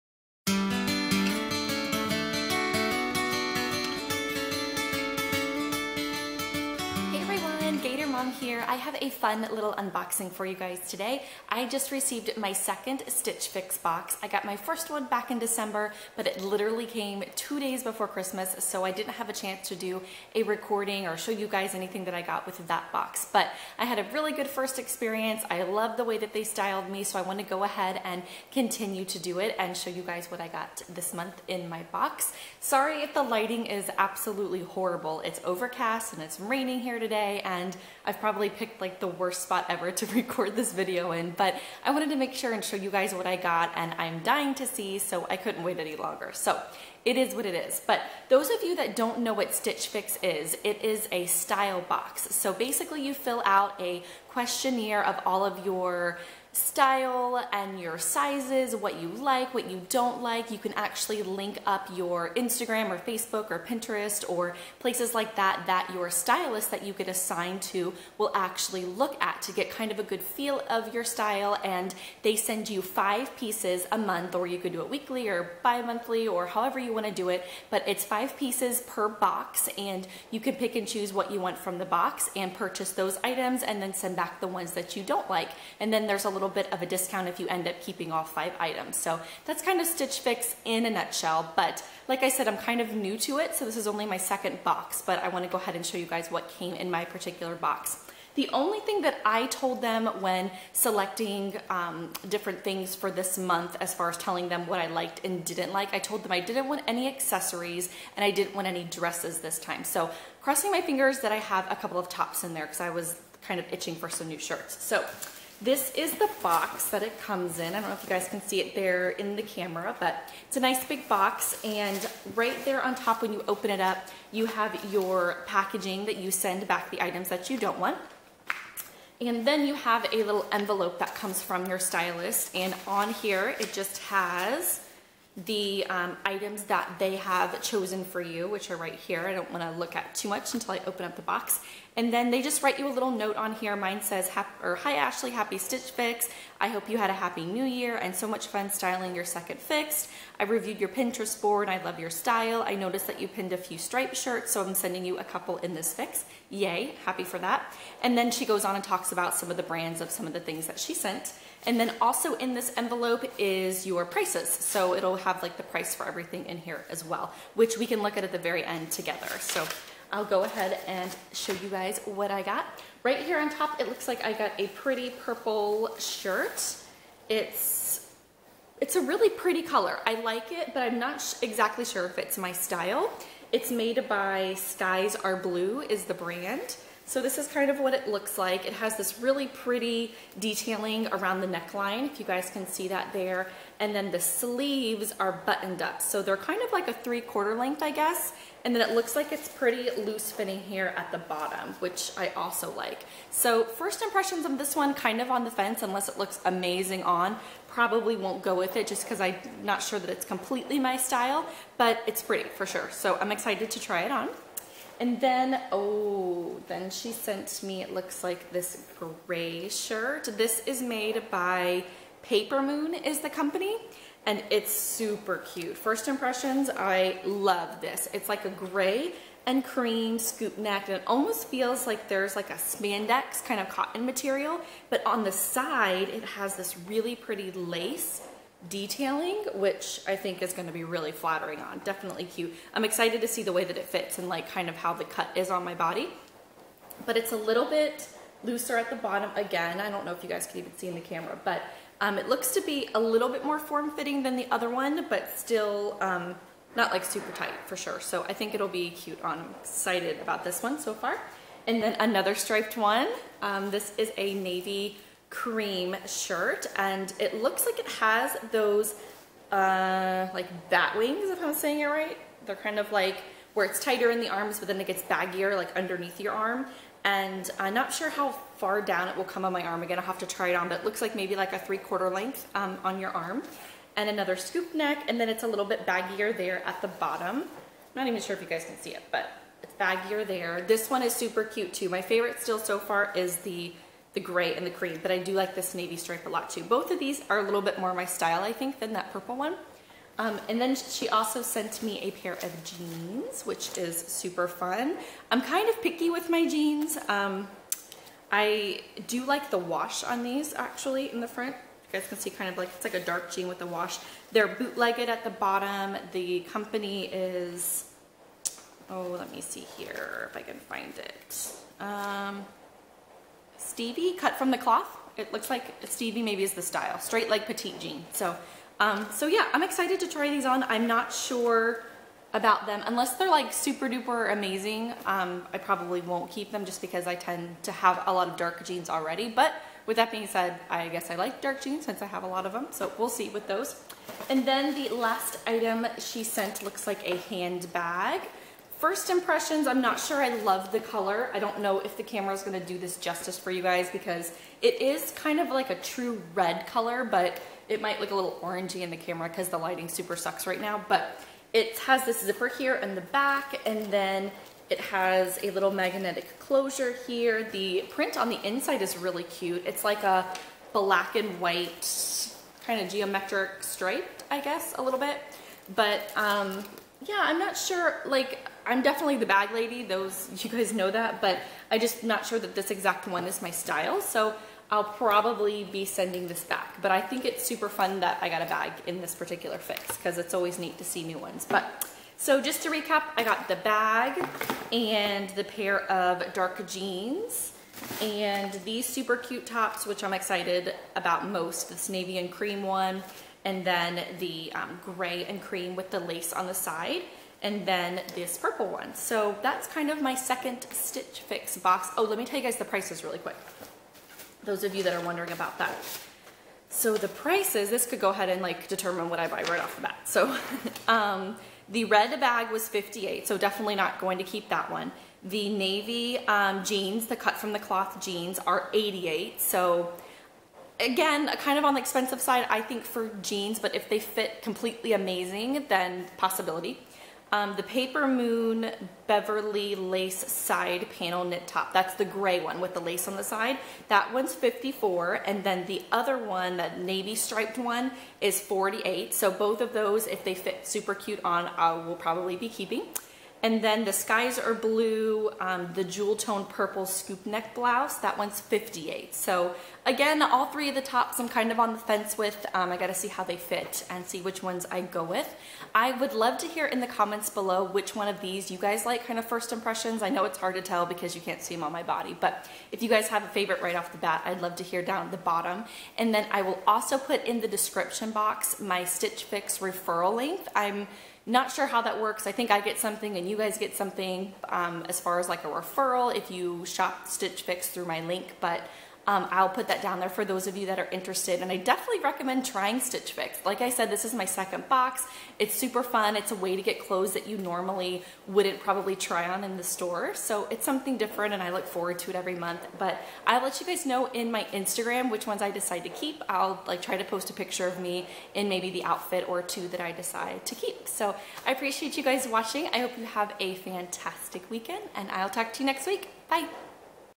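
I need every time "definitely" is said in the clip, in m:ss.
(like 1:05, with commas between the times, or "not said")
4:01, 6:18, 7:03, 8:11.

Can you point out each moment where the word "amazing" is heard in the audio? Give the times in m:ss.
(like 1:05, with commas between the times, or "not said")
3:26, 5:34, 7:14.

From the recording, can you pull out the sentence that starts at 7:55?
And then I will also put in the description box my Stitch Fix referral link.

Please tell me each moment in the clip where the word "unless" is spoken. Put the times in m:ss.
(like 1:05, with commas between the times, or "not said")
3:25, 5:32.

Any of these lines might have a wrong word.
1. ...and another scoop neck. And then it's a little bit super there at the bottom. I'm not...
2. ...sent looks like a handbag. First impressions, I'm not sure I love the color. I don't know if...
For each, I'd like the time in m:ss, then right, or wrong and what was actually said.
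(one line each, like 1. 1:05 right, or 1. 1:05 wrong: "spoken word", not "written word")
1. 4:43 wrong: "baggier", not "super"
2. 5:46 right.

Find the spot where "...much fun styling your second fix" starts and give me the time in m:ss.
2:28.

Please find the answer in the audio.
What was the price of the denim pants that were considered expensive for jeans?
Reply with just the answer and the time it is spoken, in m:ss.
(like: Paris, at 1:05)
88, at 7:08.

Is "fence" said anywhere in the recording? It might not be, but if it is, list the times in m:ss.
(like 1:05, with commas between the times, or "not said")
3:25, 7:41.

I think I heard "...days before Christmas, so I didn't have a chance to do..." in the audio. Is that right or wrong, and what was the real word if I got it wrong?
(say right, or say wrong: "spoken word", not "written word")
right.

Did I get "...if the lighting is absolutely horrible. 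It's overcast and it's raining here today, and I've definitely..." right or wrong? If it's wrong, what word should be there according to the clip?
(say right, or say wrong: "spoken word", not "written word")
wrong: "probably", not "definitely".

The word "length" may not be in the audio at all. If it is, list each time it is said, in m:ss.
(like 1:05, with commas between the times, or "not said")
3:17, 4:42.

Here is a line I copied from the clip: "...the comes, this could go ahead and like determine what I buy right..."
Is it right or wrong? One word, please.
wrong.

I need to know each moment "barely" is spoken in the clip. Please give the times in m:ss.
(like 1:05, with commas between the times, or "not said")
not said.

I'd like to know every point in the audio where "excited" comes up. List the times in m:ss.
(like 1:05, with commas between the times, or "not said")
3:33, 4:02, 4:19, 5:29, 6:40.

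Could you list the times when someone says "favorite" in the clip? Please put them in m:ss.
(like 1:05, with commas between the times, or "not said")
4:52, 7:53.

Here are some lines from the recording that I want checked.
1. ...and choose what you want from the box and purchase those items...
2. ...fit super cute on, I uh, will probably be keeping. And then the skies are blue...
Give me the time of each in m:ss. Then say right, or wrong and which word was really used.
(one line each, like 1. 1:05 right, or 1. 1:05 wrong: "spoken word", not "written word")
1. 1:20 right
2. 7:30 right.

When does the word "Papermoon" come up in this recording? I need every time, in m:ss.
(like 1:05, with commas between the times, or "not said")
3:42, 7:17.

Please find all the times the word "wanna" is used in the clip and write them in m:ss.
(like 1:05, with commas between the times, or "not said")
1:35.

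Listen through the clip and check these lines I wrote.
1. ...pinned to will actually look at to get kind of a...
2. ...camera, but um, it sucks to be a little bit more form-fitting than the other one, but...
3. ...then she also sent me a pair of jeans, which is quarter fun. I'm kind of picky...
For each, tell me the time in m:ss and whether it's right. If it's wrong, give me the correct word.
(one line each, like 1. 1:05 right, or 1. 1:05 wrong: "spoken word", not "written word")
1. 1:07 wrong: "assigned", not "pinned"
2. 4:11 wrong: "looks", not "sucks"
3. 5:00 wrong: "super", not "quarter".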